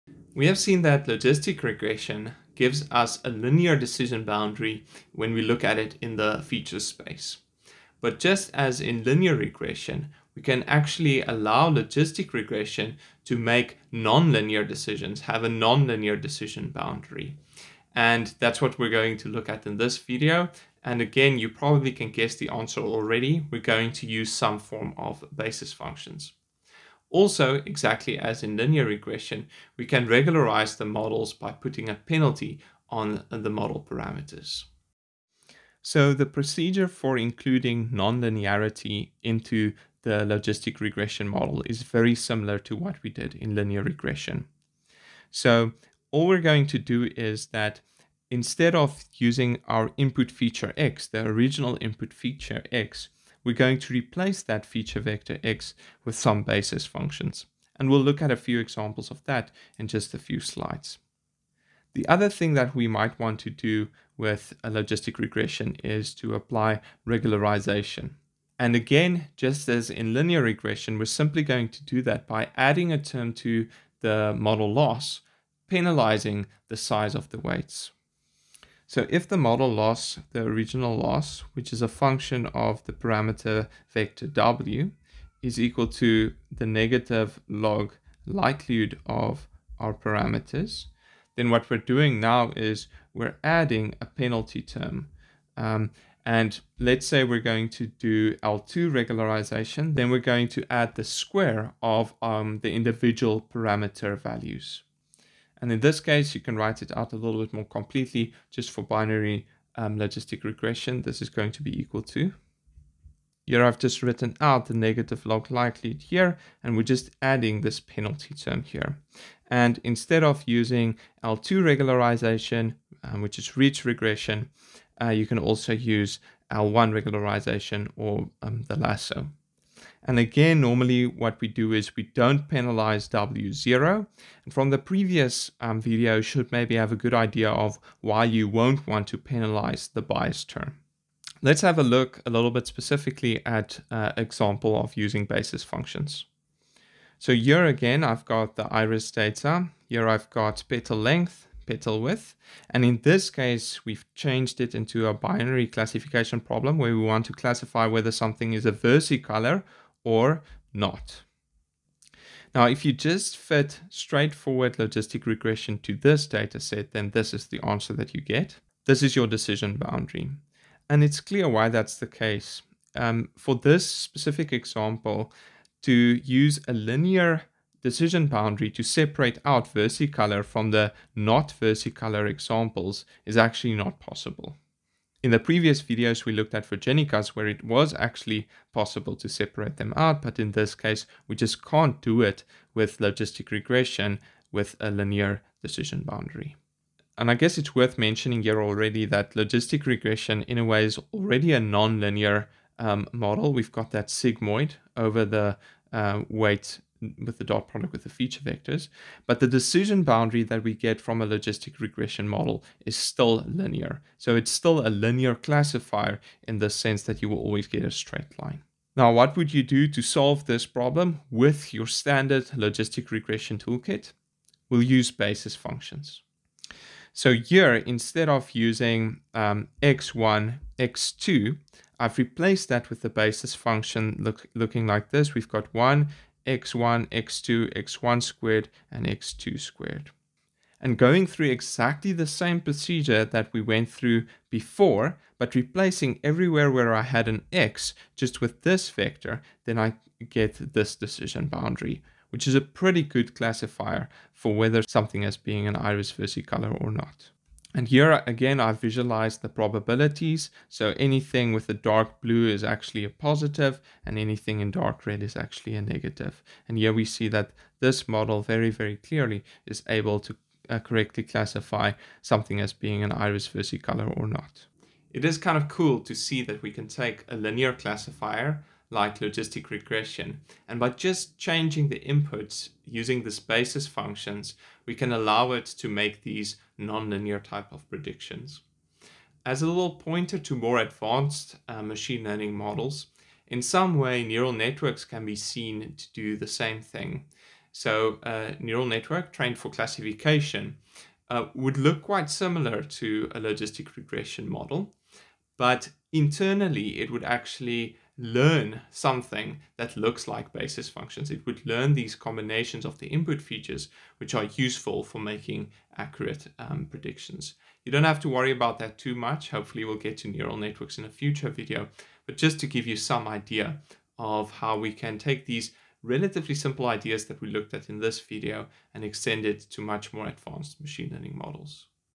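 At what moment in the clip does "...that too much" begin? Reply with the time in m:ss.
5:18.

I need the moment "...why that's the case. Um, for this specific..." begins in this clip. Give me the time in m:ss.
2:51.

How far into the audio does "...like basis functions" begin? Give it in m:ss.
5:10.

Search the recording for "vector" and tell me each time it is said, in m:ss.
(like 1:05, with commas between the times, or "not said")
0:54, 1:23, 3:28, 4:08.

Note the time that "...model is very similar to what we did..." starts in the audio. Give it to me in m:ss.
0:41.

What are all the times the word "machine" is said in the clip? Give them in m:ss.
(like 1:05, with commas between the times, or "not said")
4:51, 5:30.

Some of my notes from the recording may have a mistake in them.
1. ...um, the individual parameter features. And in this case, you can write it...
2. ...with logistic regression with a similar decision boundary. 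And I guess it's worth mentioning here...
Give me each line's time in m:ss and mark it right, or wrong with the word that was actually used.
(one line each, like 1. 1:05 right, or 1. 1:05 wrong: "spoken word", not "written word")
1. 1:42 wrong: "values", not "features"
2. 3:12 wrong: "linear", not "similar".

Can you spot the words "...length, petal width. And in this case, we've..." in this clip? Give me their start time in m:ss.
2:30.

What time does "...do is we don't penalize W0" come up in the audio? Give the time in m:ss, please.
2:11.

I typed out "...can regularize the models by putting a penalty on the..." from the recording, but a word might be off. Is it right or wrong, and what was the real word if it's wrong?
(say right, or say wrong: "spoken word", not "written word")
right.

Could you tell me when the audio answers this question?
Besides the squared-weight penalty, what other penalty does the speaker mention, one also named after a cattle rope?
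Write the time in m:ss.
2:06.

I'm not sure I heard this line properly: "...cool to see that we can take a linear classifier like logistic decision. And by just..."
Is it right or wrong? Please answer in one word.
wrong.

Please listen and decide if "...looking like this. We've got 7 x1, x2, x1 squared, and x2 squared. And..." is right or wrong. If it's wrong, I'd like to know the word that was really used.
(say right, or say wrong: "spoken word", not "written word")
wrong: "1", not "7".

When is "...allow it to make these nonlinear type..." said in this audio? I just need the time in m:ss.
4:45.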